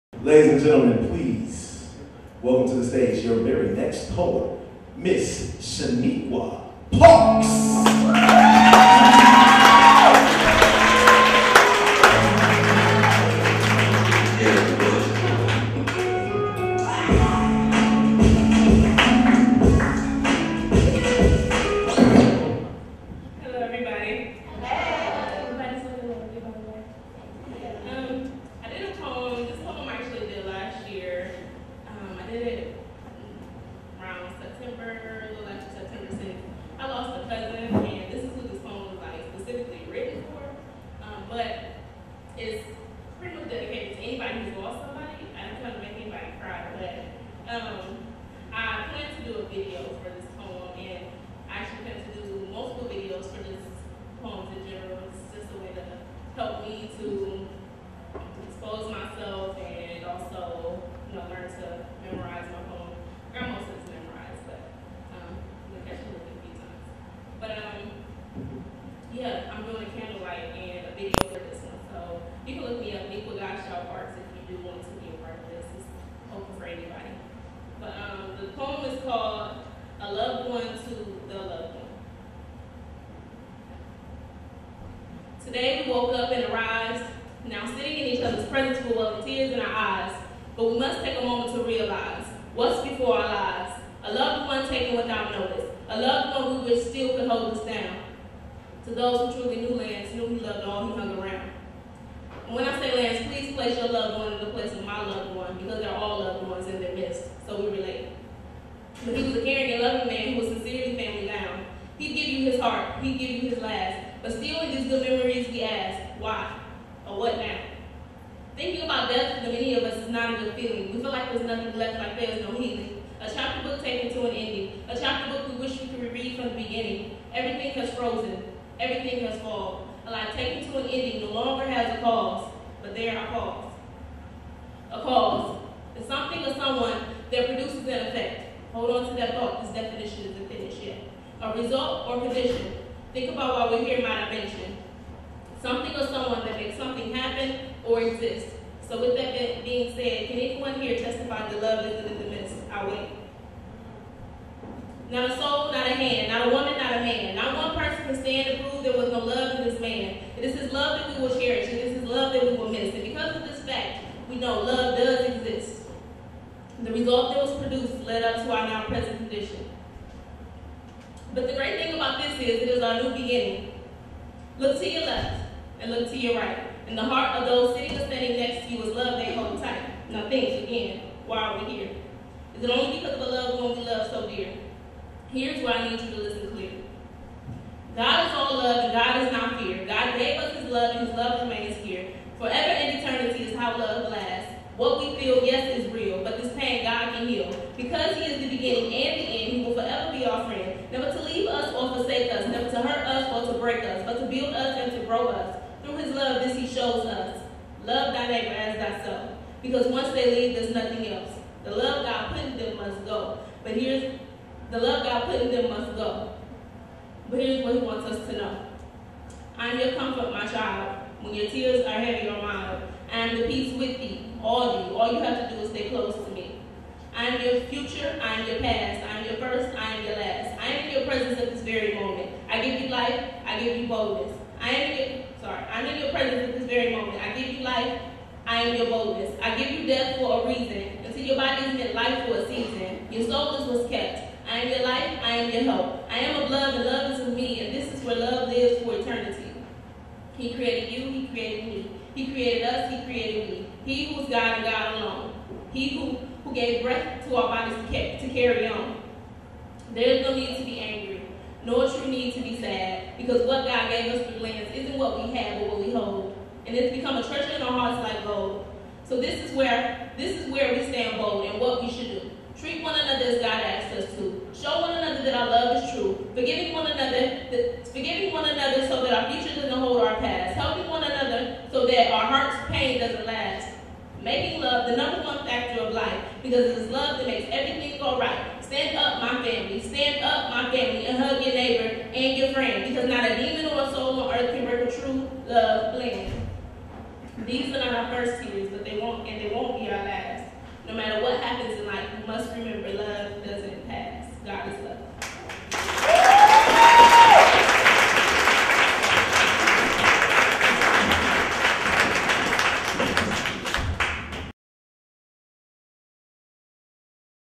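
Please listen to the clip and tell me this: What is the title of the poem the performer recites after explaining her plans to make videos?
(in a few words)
A Loved One to the Loved One.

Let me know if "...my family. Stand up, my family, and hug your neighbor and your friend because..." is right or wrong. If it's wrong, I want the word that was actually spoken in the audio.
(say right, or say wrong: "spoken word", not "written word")
right.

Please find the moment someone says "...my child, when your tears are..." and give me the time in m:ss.
3:40.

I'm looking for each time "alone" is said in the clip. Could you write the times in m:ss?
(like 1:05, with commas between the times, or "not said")
4:14.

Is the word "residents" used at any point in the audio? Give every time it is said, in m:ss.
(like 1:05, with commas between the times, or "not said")
not said.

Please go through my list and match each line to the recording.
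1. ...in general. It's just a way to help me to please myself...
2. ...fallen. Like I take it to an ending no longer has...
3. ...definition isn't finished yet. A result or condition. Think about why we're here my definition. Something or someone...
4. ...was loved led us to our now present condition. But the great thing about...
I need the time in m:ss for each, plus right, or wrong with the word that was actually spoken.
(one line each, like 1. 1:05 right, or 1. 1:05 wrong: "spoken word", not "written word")
1. 0:54 wrong: "expose", not "please"
2. 2:09 right
3. 2:19 wrong: "dimension", not "definition"
4. 2:47 wrong: "produced", not "loved".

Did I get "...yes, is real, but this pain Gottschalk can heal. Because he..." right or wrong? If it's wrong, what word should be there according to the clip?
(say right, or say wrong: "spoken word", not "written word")
wrong: "God", not "Gottschalk".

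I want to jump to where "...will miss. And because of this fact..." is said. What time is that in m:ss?
2:42.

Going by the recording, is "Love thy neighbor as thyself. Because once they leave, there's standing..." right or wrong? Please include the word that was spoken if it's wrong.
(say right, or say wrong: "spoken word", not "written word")
wrong: "nothing", not "standing".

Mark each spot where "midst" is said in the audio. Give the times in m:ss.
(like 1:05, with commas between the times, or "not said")
1:46, 2:32.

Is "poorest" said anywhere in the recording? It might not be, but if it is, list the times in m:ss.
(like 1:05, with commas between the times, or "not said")
not said.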